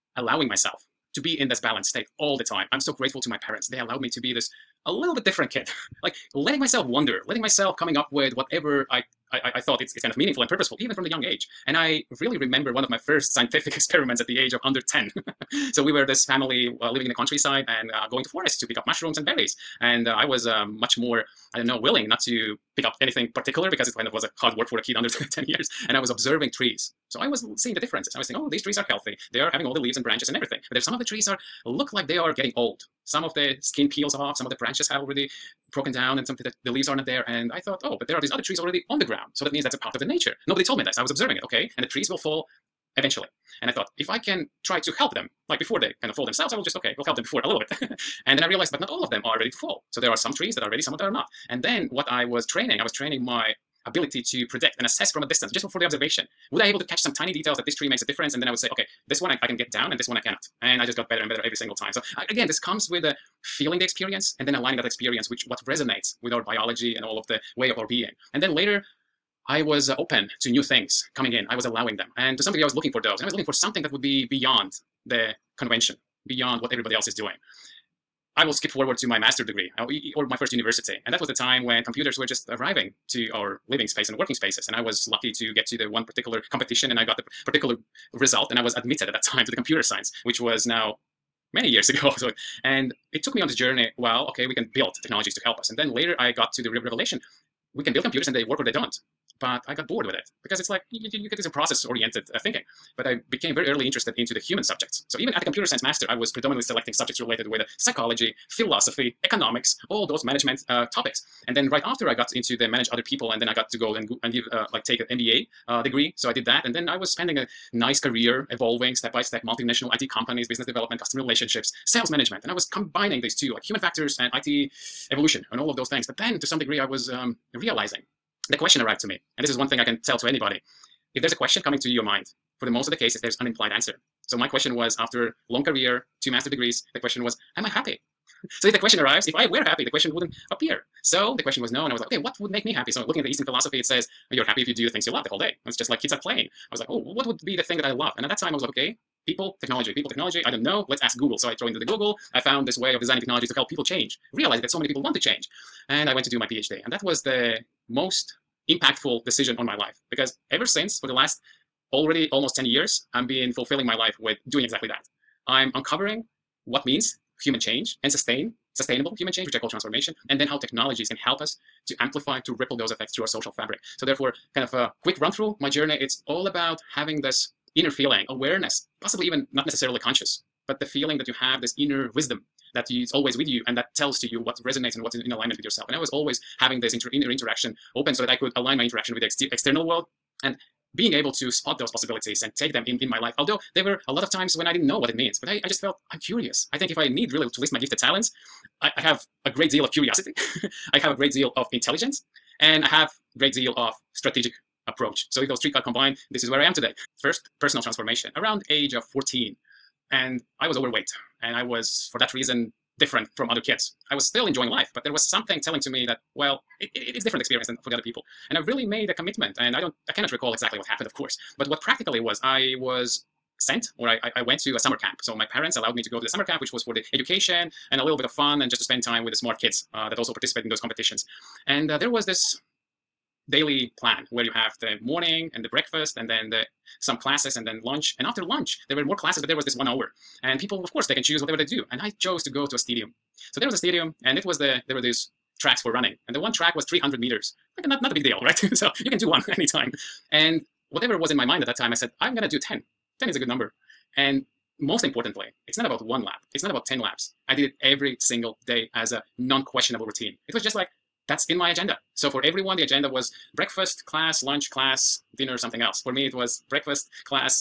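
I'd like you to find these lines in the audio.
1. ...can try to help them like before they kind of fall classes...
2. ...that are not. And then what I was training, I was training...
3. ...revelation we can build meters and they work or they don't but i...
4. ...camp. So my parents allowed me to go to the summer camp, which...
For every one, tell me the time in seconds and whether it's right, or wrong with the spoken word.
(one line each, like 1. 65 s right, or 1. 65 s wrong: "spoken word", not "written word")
1. 44 s wrong: "themselves", not "classes"
2. 50 s right
3. 96 s wrong: "computers", not "meters"
4. 224 s right.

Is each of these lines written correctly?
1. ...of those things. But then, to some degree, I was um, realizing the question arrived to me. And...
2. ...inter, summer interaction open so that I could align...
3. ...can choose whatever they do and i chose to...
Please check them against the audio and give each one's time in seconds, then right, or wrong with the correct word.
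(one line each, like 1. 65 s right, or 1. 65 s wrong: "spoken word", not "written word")
1. 125 s right
2. 186 s wrong: "inner", not "summer"
3. 241 s right.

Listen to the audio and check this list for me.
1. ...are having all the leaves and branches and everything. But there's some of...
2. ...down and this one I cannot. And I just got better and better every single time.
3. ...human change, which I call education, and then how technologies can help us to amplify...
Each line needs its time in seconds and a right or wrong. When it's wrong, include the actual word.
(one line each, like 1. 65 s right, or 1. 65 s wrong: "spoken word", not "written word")
1. 29 s right
2. 59 s right
3. 169 s wrong: "transformation", not "education".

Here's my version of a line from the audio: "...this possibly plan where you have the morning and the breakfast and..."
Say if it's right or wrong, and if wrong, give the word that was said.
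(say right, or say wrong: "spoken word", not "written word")
wrong: "daily", not "possibly".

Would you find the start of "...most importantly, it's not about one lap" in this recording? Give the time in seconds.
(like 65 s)
254 s.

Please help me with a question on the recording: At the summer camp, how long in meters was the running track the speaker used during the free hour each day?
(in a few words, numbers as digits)
300 meters.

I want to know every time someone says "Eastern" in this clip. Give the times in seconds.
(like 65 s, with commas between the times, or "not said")
143 s.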